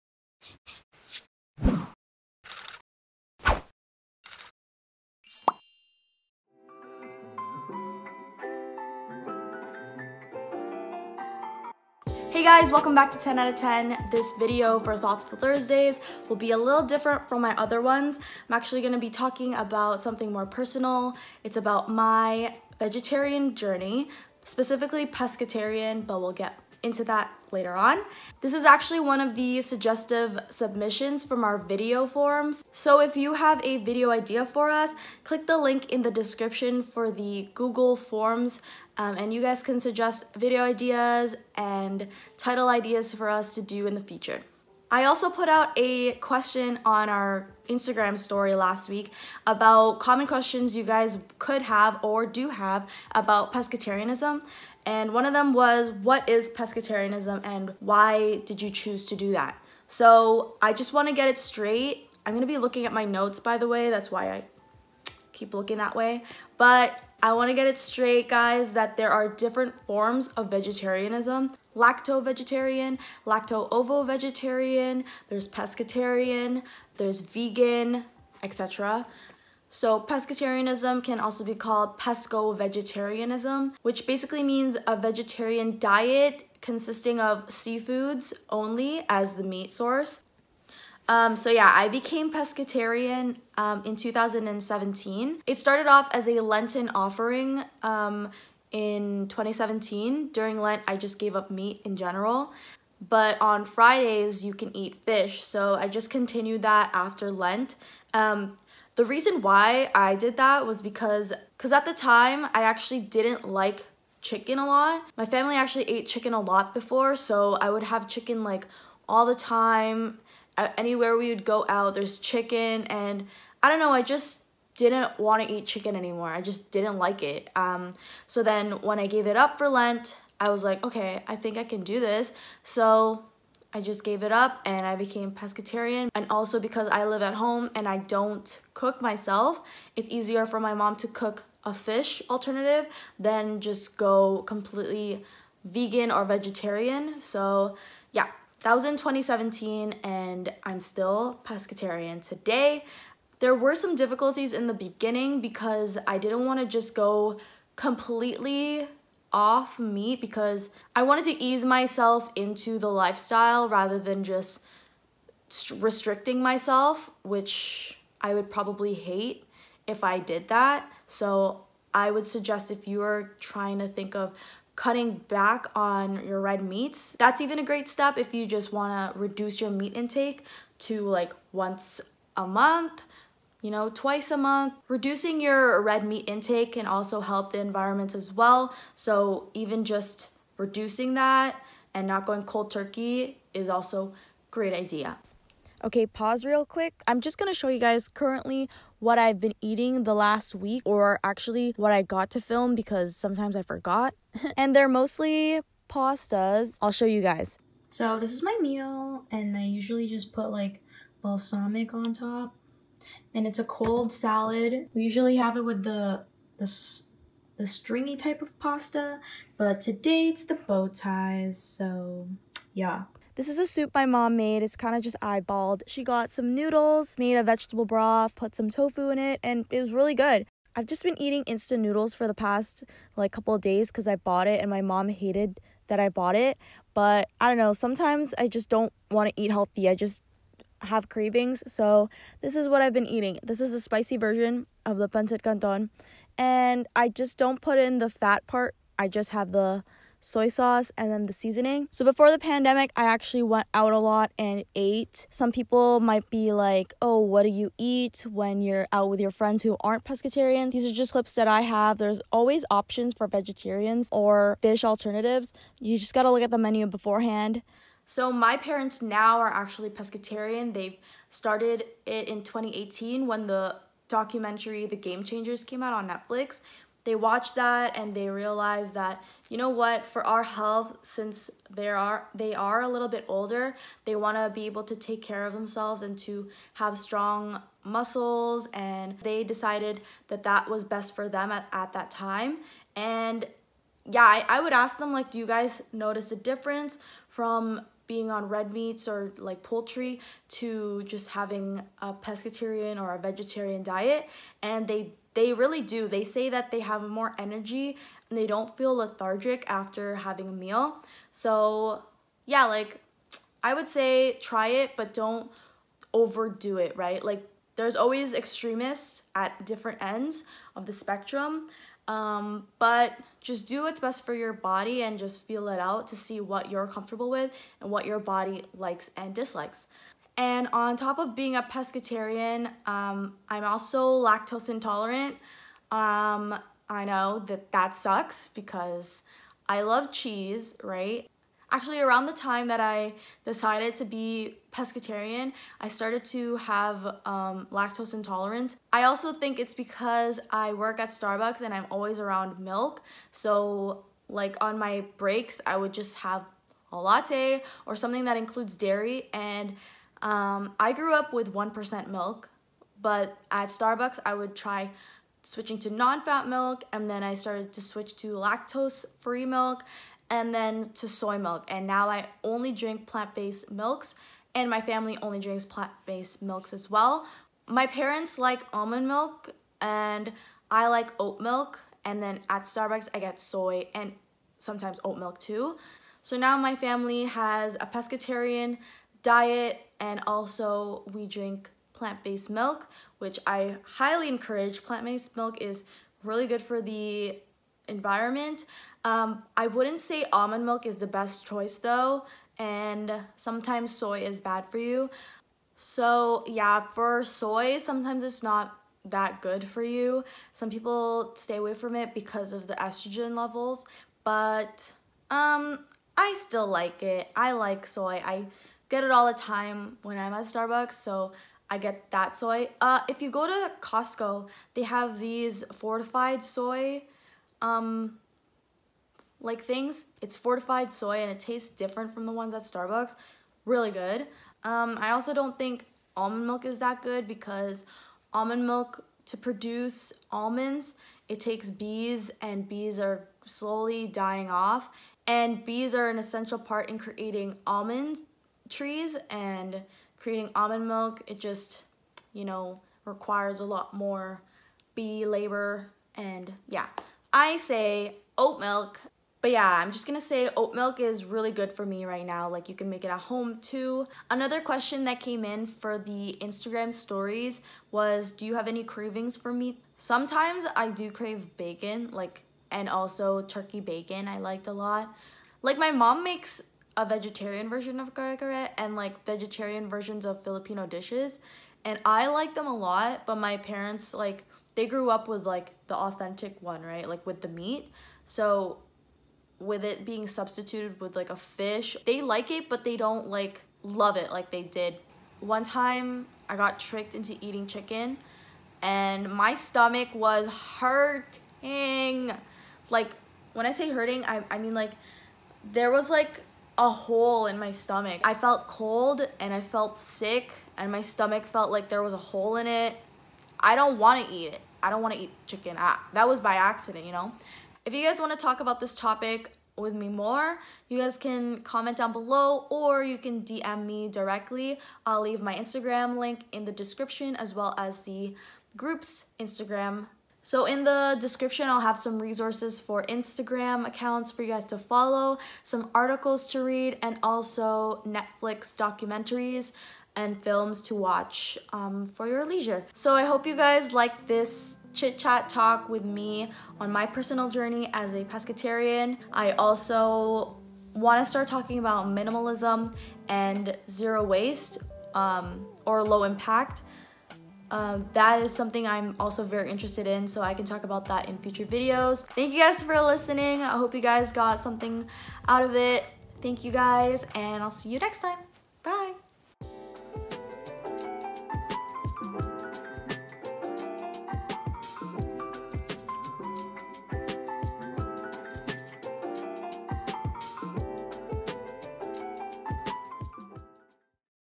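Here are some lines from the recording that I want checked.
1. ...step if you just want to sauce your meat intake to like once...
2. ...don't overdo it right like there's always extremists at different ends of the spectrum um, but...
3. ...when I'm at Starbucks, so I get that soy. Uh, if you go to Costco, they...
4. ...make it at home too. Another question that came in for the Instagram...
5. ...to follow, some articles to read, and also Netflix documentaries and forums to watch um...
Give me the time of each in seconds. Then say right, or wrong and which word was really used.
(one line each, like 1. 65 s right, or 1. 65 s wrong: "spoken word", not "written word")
1. 177 s wrong: "reduce", not "sauce"
2. 315 s right
3. 420 s right
4. 462 s right
5. 534 s wrong: "films", not "forums".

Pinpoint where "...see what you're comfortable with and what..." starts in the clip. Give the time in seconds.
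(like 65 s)
326 s.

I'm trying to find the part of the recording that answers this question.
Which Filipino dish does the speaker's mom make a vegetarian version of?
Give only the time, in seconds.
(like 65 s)
478 s.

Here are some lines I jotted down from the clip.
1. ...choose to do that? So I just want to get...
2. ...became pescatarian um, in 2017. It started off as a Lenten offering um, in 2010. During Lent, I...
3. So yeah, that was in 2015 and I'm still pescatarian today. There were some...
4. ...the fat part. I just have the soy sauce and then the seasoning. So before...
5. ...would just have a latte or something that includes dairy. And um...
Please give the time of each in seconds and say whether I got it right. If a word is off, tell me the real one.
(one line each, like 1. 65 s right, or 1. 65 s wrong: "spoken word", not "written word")
1. 58 s right
2. 91 s wrong: "2017", not "2010"
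3. 147 s wrong: "2017", not "2015"
4. 247 s right
5. 355 s right.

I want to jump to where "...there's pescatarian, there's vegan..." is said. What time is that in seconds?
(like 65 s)
75 s.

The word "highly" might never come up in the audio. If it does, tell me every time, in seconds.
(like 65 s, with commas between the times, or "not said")
393 s.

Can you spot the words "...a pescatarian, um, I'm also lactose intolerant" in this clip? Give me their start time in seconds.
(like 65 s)
331 s.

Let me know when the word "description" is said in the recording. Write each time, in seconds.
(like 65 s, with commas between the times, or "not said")
36 s, 526 s, 531 s.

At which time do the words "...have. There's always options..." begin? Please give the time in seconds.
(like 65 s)
261 s.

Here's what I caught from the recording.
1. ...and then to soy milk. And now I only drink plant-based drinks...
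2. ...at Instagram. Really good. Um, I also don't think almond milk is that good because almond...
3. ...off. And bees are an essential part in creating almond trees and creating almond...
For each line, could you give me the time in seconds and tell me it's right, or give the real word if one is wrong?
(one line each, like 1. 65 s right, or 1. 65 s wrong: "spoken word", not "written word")
1. 370 s wrong: "milks", not "drinks"
2. 432 s wrong: "Starbucks", not "Instagram"
3. 444 s right.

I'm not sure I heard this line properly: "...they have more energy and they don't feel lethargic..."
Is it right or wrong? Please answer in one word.
right.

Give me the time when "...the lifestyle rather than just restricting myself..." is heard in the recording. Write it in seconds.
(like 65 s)
162 s.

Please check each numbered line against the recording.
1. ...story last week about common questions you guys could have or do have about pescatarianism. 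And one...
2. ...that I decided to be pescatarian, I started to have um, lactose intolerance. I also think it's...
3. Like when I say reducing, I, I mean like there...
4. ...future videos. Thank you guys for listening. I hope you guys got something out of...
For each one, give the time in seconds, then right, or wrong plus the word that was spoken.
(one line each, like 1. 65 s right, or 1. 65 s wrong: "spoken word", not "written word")
1. 48 s right
2. 342 s right
3. 502 s wrong: "hurting", not "reducing"
4. 561 s right.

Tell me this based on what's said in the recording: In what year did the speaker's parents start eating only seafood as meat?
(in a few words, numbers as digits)
2018.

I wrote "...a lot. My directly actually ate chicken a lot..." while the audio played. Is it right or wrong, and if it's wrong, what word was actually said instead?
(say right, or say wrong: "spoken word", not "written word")
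wrong: "family", not "directly".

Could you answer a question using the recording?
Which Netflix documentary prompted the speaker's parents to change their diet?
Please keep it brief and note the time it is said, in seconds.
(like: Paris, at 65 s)
The Game Changers, at 274 s.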